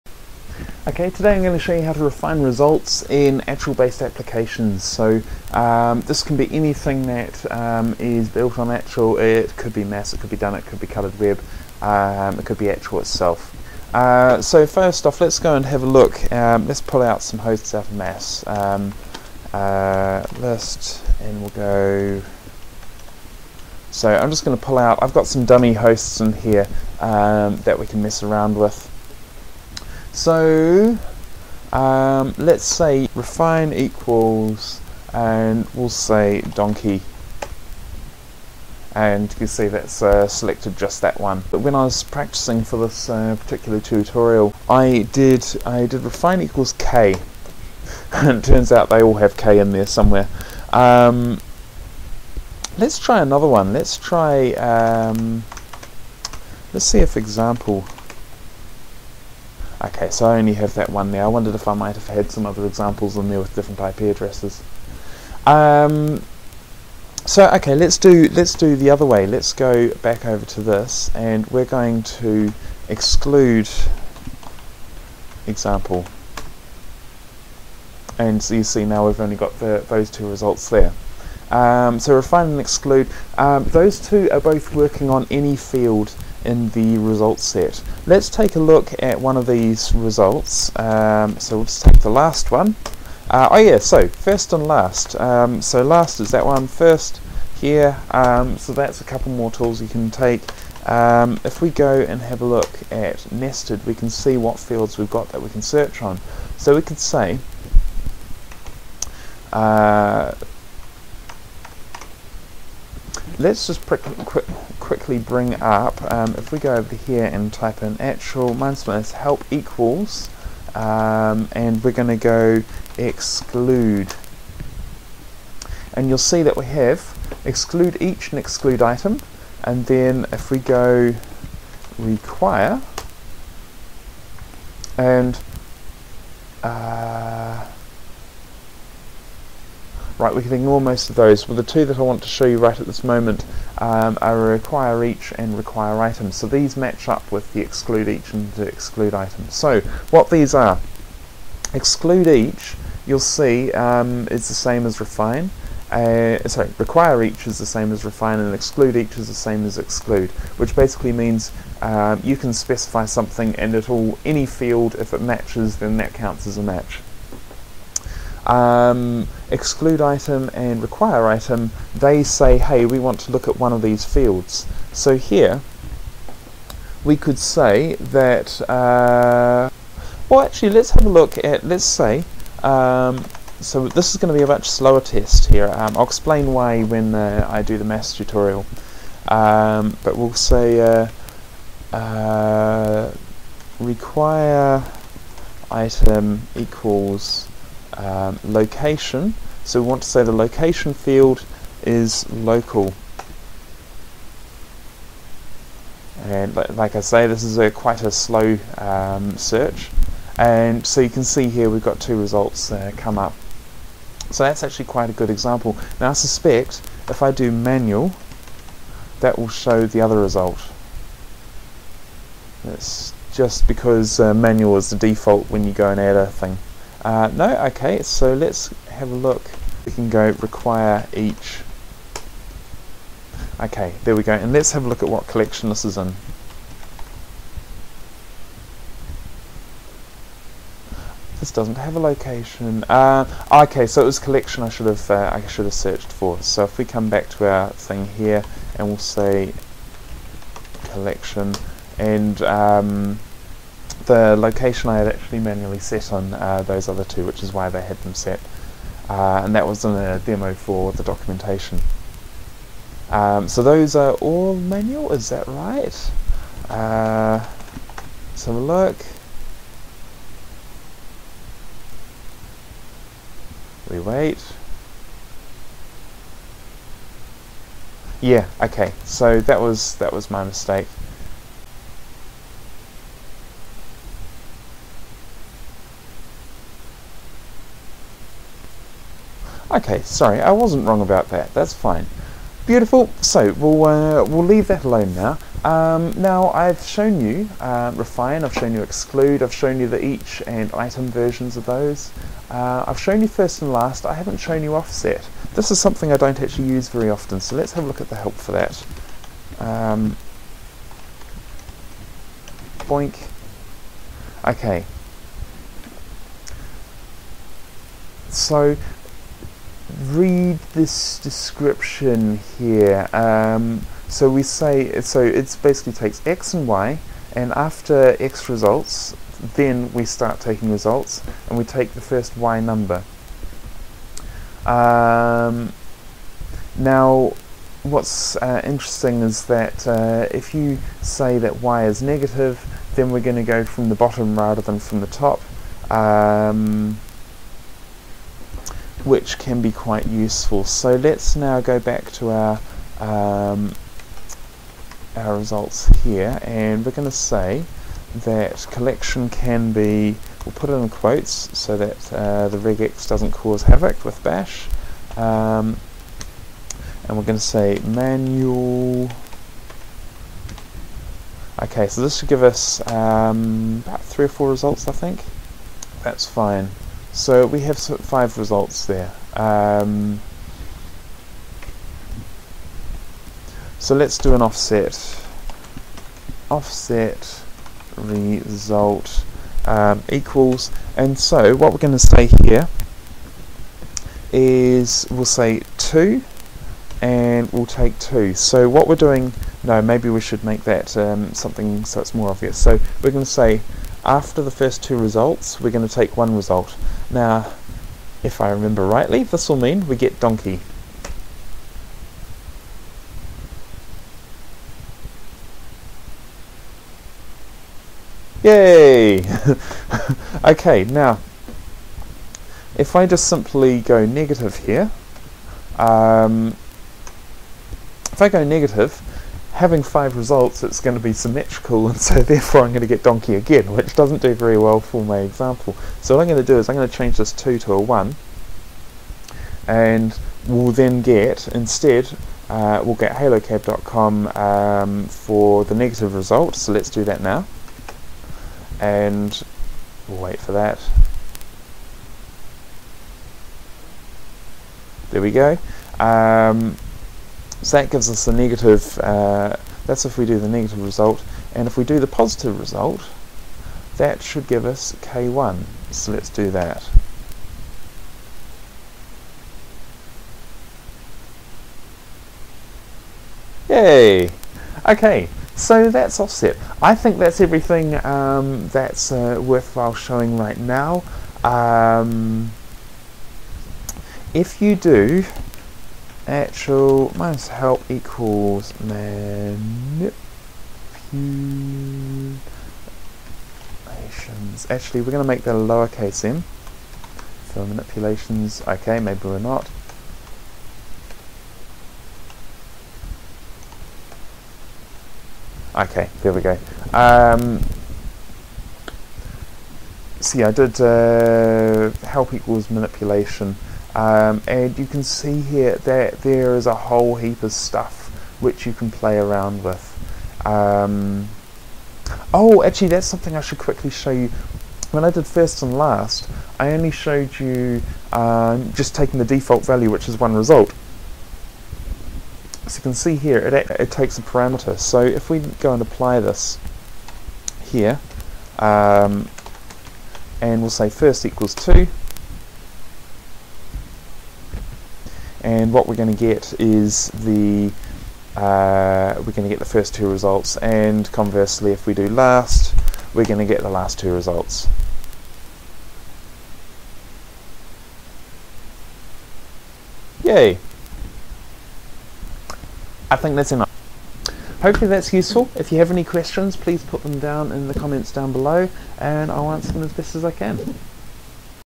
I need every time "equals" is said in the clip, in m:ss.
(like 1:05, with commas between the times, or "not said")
0:33, 0:46, 1:59, 3:16, 6:30, 8:07, 8:32, 9:01.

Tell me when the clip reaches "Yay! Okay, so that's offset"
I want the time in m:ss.
7:53.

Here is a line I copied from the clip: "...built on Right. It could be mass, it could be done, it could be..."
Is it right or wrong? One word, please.
wrong.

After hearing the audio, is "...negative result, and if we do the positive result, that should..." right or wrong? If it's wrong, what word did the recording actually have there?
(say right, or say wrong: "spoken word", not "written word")
right.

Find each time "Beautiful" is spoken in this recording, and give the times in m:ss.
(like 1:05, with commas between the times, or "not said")
4:52.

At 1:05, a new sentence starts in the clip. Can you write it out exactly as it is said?
Um, so okay, let's do let's do the other way.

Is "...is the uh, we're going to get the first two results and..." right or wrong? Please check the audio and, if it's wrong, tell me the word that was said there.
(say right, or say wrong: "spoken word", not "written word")
right.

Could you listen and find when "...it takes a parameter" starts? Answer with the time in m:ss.
8:53.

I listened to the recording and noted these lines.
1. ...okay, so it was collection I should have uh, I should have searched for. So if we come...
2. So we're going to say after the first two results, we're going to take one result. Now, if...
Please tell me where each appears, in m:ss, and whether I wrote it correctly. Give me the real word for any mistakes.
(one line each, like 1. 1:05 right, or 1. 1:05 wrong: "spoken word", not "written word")
1. 4:03 right
2. 6:42 right.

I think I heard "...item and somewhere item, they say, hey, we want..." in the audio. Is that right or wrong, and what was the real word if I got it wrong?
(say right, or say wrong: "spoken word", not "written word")
wrong: "require", not "somewhere".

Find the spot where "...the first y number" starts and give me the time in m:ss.
5:31.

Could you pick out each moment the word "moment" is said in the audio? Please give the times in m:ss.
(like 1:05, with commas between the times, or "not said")
2:23.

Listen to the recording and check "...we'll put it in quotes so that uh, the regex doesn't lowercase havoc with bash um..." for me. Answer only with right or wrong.
wrong.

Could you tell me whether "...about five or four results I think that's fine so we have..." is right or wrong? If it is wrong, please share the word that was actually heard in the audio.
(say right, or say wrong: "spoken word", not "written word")
wrong: "three", not "five".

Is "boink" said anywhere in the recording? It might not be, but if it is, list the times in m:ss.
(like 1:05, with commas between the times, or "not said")
5:12.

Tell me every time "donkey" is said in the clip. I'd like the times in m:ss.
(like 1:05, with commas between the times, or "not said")
0:36, 6:50, 7:13.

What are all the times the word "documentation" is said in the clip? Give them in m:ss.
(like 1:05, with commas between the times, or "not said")
4:21.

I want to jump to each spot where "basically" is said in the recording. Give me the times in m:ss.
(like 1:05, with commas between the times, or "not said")
2:40, 5:25.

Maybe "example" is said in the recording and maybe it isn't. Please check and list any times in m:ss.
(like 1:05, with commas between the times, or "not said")
0:57, 1:02, 1:15, 3:35, 7:15.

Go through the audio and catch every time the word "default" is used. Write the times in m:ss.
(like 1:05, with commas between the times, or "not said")
3:44, 8:49.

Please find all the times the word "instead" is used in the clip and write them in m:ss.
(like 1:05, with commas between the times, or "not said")
7:21.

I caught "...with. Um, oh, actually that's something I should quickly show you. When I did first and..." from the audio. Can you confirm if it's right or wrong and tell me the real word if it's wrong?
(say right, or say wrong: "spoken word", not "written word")
right.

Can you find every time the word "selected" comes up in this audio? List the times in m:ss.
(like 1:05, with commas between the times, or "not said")
0:40.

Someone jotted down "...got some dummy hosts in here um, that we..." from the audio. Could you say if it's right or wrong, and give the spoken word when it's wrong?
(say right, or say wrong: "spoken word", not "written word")
right.